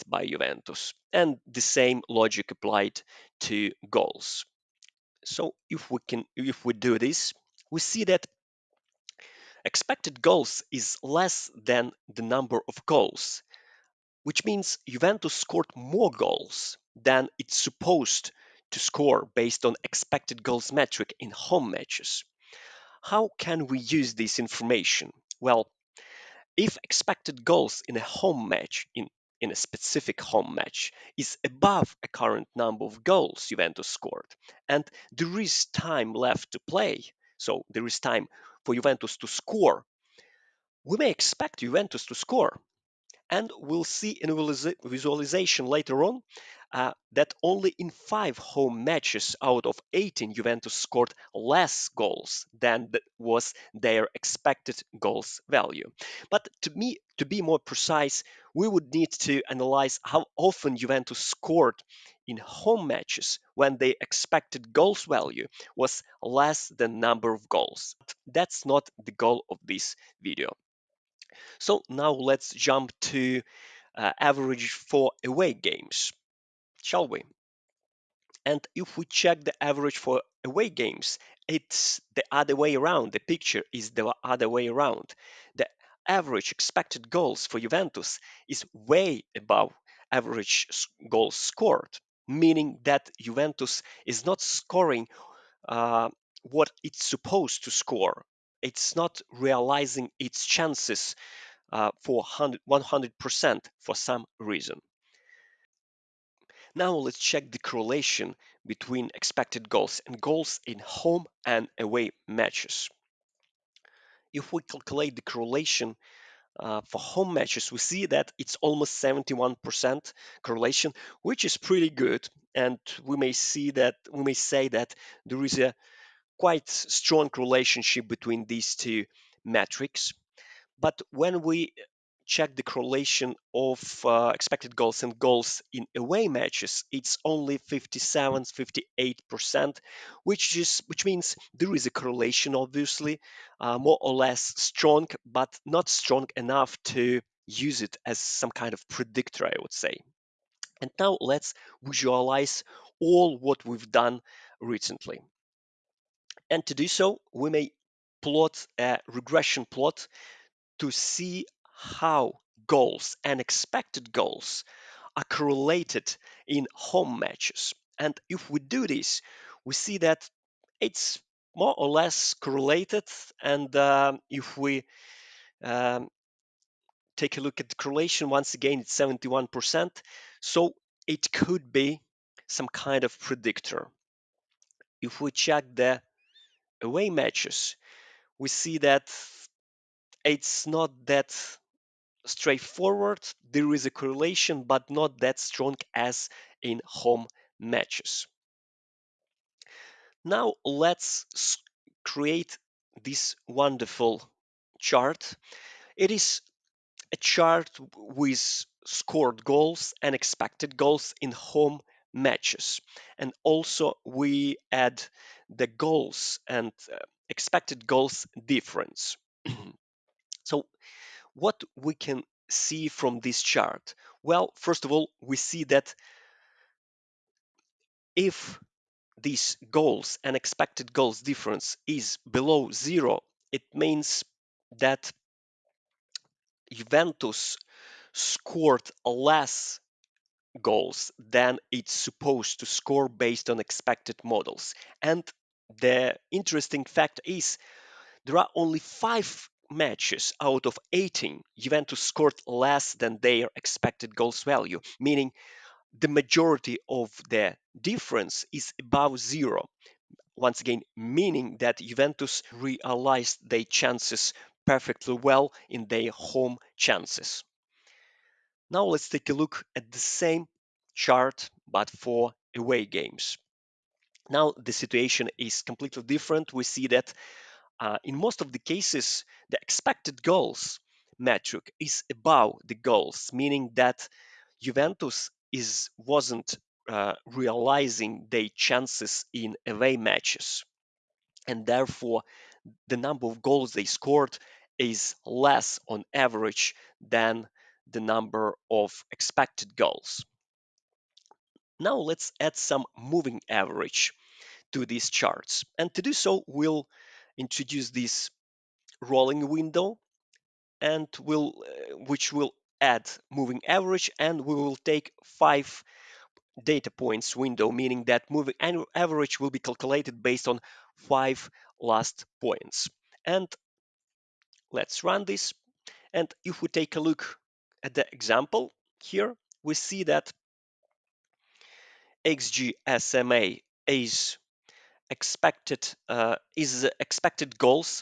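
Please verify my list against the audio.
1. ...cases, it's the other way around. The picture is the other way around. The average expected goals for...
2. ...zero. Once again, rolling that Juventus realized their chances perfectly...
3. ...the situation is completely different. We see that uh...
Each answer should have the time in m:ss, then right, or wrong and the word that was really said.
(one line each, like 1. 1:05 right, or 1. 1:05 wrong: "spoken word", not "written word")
1. 1:20 wrong: "games", not "cases"
2. 4:19 wrong: "meaning", not "rolling"
3. 4:34 right.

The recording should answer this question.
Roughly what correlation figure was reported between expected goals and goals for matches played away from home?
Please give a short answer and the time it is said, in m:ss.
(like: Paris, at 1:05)
57, 58%, at 2:17.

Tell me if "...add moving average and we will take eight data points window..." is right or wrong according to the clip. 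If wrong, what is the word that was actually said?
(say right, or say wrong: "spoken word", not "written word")
wrong: "five", not "eight".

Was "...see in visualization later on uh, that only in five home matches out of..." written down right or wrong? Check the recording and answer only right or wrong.
right.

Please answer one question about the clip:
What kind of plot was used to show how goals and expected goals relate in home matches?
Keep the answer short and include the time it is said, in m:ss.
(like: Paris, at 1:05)
Regression plot, at 2:39.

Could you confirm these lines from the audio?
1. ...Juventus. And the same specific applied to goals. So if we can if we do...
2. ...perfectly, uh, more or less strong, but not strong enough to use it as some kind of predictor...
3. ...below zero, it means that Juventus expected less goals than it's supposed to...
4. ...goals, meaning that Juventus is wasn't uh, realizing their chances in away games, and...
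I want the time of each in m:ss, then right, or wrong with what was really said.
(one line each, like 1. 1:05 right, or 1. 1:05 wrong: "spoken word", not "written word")
1. 0:00 wrong: "logic", not "specific"
2. 2:22 wrong: "obviously", not "perfectly"
3. 3:52 wrong: "scored", not "expected"
4. 4:42 wrong: "matches", not "games".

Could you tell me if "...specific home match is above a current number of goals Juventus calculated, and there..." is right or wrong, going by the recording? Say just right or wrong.
wrong.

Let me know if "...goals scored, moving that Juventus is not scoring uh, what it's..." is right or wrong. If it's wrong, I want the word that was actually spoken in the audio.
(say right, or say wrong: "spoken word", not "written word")
wrong: "meaning", not "moving".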